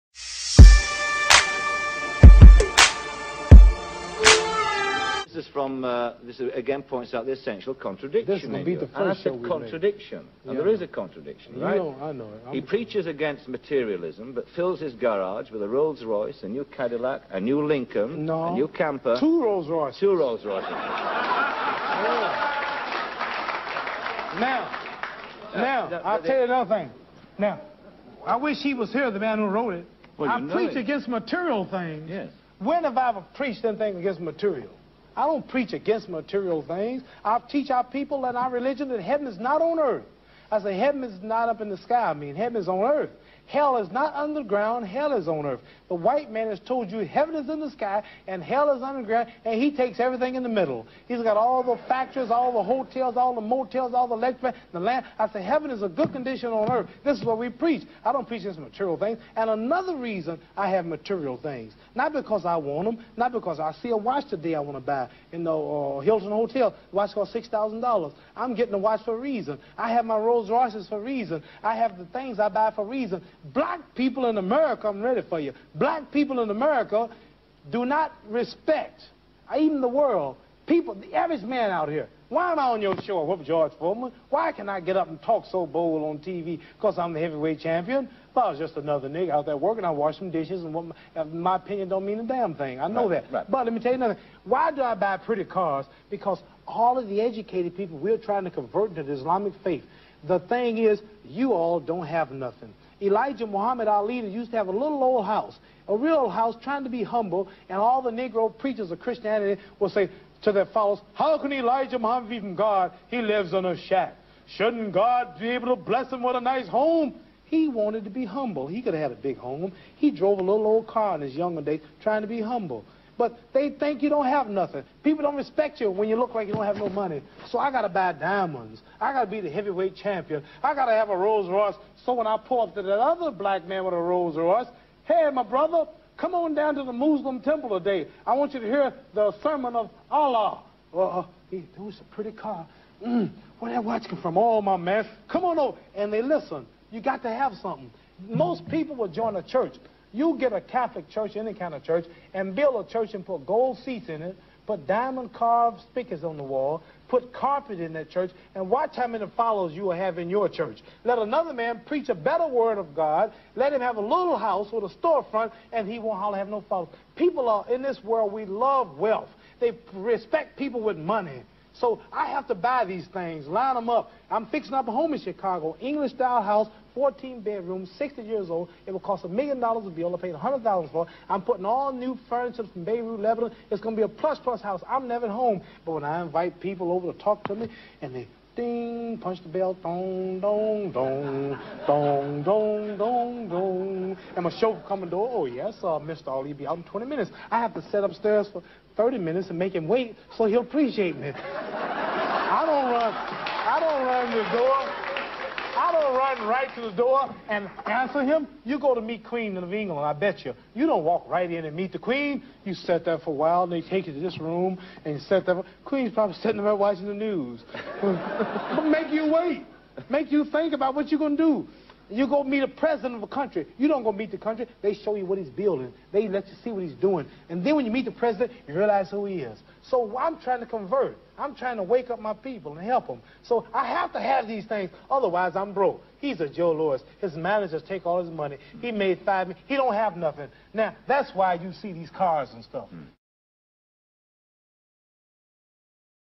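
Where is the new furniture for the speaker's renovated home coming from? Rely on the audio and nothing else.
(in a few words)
Beirut, Lebanon.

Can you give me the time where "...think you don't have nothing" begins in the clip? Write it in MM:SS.
02:03.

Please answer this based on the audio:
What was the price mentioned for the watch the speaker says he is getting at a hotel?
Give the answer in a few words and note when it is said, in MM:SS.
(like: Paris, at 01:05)
$6,000, at 01:07.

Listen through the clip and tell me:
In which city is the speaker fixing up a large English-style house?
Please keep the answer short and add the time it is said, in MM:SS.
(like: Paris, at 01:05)
Chicago, at 02:55.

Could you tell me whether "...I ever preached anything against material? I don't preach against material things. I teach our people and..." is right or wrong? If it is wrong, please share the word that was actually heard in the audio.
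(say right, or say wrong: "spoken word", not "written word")
right.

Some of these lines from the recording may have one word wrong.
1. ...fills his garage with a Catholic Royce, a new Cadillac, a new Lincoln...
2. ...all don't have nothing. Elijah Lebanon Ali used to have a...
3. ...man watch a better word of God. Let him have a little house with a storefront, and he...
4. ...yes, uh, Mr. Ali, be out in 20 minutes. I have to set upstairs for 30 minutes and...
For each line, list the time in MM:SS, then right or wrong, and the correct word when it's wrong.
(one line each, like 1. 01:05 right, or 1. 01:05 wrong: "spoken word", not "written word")
1. 00:14 wrong: "Rolls", not "Catholic"
2. 01:41 wrong: "Muhammad", not "Lebanon"
3. 02:41 wrong: "preach", not "watch"
4. 03:15 right.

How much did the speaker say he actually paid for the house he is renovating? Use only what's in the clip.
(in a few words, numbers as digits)
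100,000.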